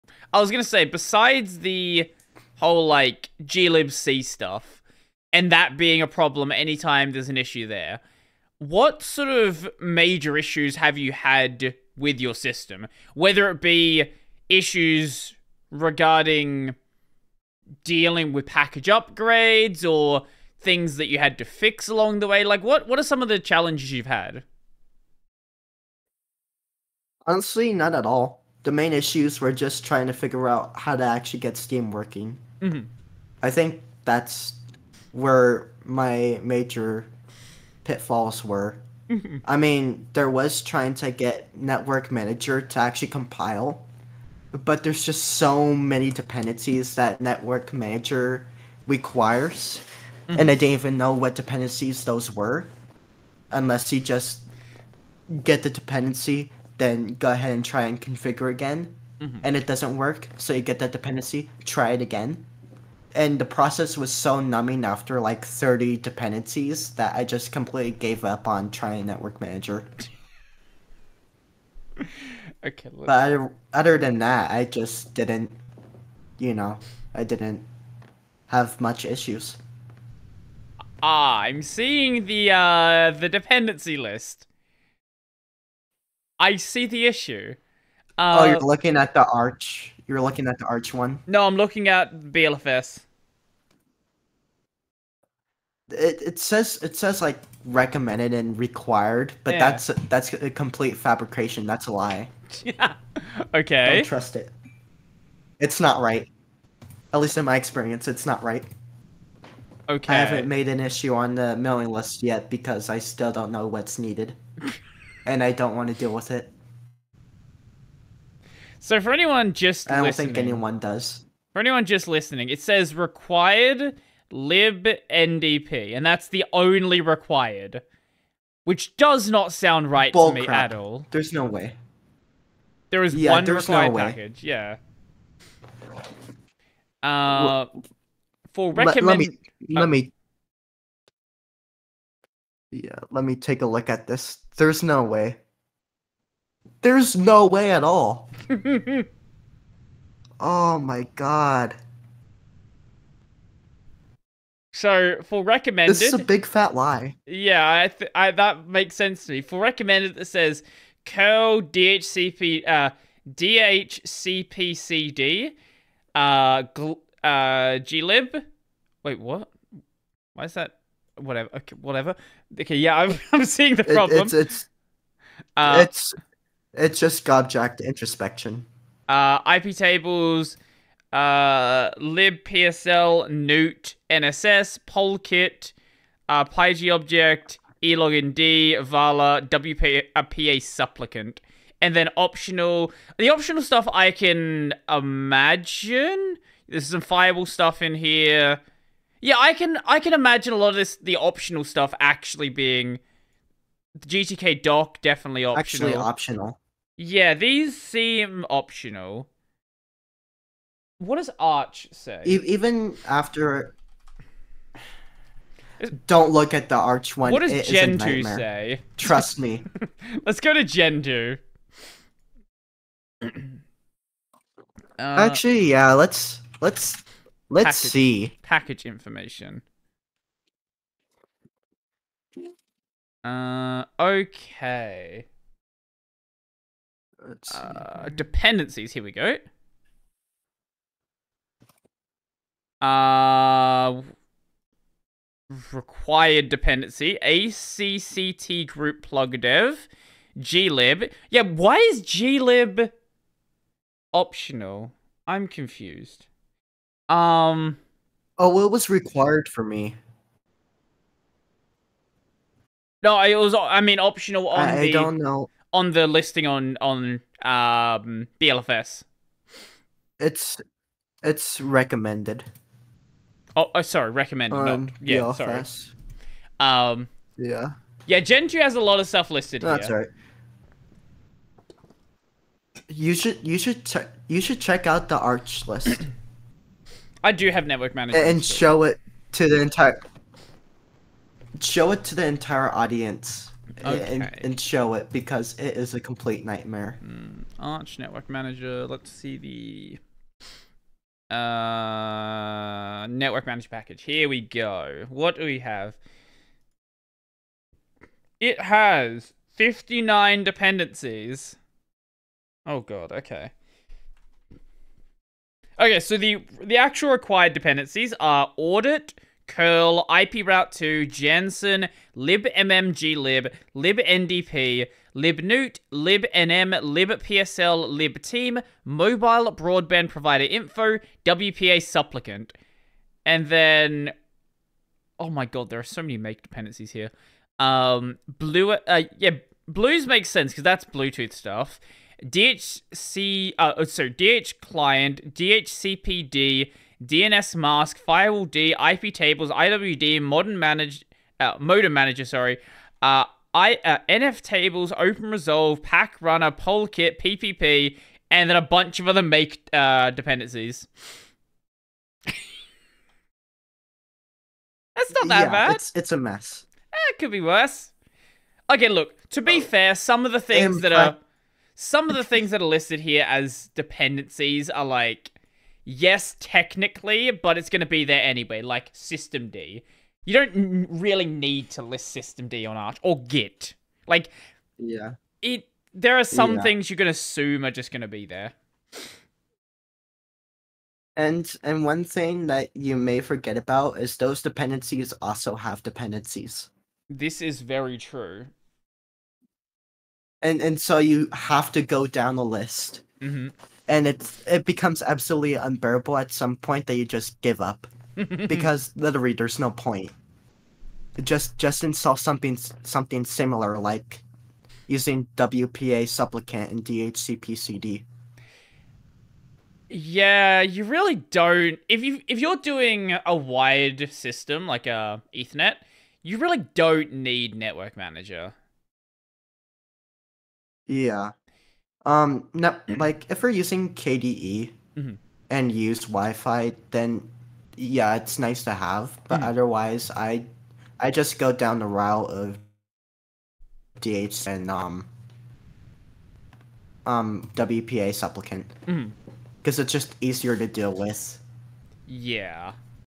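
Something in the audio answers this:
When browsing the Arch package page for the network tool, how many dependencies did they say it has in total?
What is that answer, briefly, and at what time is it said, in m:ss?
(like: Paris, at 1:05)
59, at 5:09.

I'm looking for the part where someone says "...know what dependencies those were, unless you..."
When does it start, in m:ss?
0:50.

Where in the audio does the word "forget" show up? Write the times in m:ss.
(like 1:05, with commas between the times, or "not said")
6:33.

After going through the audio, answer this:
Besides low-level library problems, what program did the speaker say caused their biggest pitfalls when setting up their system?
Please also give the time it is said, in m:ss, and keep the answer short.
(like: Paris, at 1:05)
Steam, at 0:31.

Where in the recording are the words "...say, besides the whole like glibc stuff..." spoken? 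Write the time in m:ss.
0:00.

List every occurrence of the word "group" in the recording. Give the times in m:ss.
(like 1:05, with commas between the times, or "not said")
4:08.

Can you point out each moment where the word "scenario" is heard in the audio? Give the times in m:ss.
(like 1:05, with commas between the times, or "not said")
not said.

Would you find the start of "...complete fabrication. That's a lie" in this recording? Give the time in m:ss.
1:40.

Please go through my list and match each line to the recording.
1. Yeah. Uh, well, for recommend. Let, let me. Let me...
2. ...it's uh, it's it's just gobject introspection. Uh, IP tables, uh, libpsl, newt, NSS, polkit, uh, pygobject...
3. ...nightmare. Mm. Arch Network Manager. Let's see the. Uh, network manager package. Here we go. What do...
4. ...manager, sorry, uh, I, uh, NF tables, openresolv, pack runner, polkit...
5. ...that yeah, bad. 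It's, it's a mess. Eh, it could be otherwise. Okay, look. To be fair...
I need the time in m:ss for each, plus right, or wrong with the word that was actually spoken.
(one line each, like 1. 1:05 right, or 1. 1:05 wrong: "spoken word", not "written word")
1. 2:14 right
2. 2:54 right
3. 4:56 right
4. 5:51 right
5. 6:05 wrong: "worse", not "otherwise".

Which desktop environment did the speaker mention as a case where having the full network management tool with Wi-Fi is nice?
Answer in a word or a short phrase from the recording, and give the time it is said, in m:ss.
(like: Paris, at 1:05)
KDE, at 7:13.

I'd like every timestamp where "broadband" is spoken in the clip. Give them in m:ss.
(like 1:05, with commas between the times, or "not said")
5:29.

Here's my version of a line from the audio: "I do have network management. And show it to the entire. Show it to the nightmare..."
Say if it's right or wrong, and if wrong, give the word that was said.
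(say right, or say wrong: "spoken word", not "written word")
wrong: "entire", not "nightmare".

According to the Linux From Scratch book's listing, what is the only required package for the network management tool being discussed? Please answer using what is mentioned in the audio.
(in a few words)
libndp.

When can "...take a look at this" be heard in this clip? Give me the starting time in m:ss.
2:23.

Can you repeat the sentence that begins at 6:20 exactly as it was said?
You don't really need to list System D on Arch or Git.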